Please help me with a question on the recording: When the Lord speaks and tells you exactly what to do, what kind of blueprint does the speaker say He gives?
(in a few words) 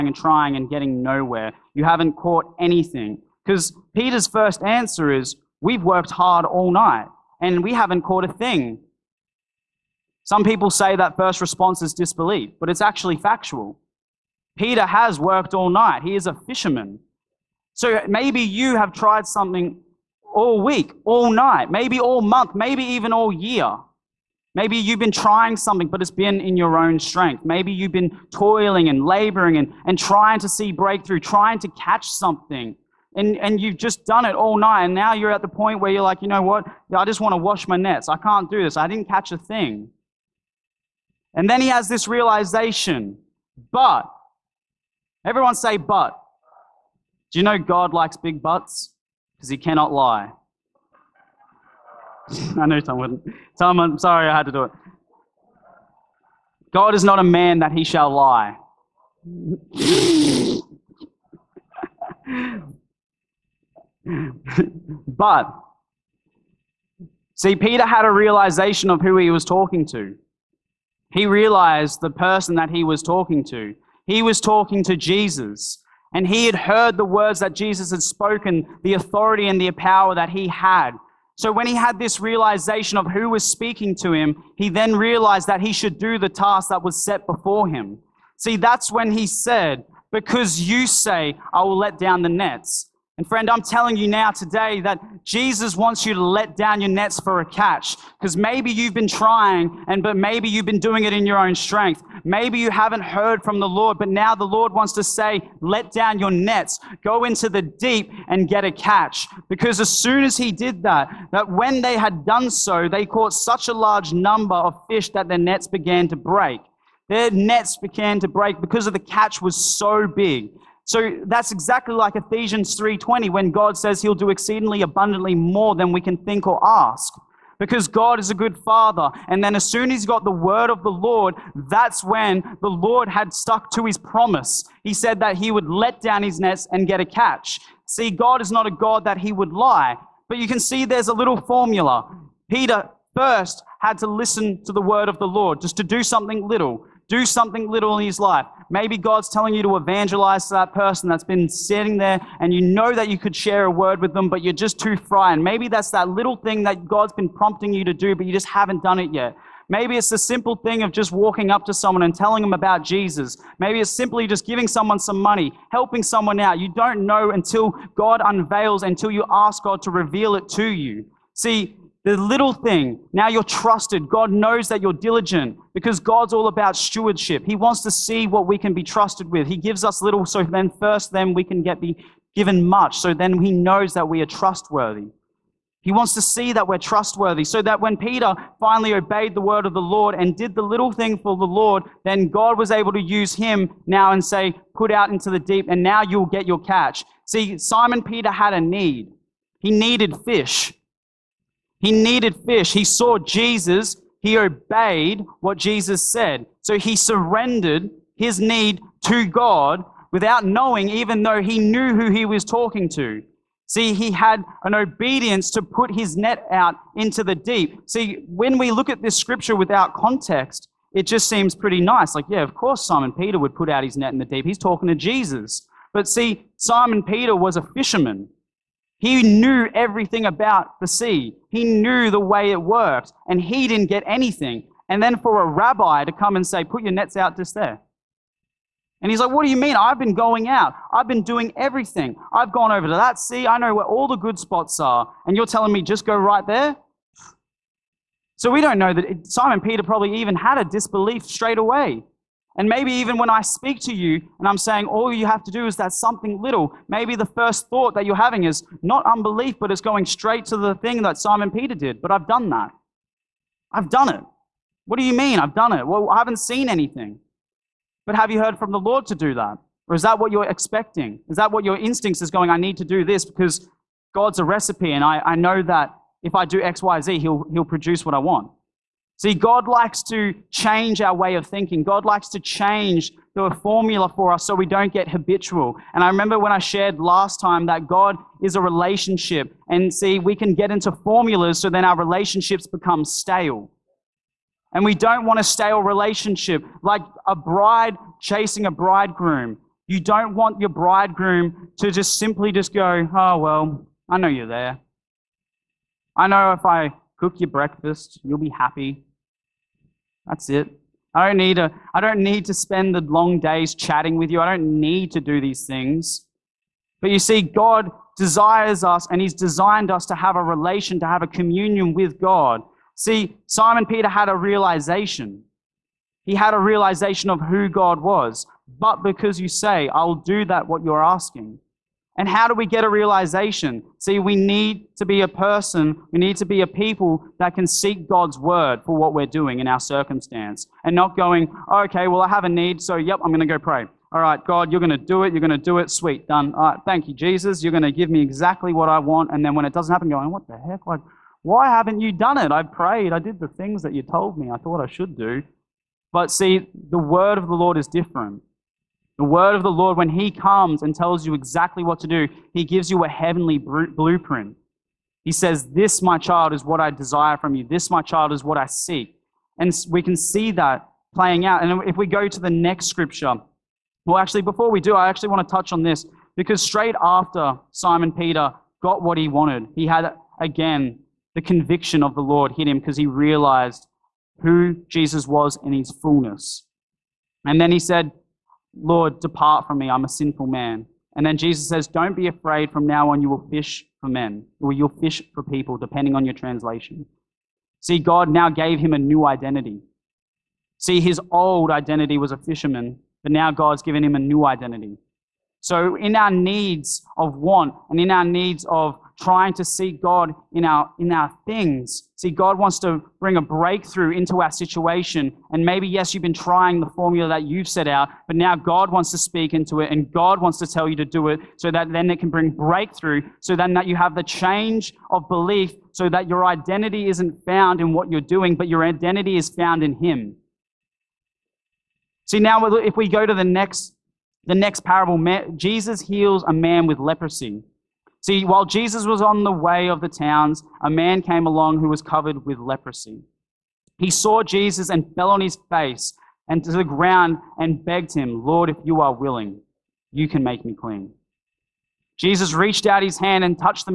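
heavenly blueprint.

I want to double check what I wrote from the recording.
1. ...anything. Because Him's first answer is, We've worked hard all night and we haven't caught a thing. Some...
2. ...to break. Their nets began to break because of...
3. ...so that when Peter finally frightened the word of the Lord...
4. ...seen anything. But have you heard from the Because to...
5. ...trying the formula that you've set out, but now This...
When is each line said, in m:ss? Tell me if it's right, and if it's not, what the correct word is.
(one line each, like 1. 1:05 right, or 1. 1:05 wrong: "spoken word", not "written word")
1. 0:02 wrong: "Peter", not "Him"
2. 1:56 right
3. 3:07 wrong: "obeyed", not "frightened"
4. 4:26 wrong: "Lord", not "Because"
5. 6:56 wrong: "God", not "This".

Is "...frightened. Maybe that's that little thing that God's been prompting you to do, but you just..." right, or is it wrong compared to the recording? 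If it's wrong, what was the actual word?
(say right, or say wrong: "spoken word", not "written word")
right.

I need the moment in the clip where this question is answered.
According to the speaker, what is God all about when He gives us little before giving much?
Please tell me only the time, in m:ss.
2:56.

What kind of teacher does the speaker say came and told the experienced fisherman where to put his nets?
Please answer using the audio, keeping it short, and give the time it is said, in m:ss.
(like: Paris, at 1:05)
rabbi, at 3:55.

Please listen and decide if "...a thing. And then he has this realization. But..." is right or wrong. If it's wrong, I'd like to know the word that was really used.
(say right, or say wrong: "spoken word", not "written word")
right.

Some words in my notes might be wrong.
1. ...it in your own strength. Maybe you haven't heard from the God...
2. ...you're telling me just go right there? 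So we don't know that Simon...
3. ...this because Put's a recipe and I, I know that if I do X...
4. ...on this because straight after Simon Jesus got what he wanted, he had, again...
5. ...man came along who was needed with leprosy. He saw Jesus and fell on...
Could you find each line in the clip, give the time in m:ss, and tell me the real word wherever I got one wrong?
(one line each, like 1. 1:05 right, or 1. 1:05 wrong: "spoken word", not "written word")
1. 1:41 wrong: "Lord", not "God"
2. 4:05 right
3. 4:33 wrong: "God", not "Put"
4. 6:15 wrong: "Peter", not "Jesus"
5. 7:20 wrong: "covered", not "needed".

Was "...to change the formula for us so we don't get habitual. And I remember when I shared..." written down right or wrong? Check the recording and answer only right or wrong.
right.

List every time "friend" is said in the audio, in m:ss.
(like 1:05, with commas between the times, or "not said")
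1:33.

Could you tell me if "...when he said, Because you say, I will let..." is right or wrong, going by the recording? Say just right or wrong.
right.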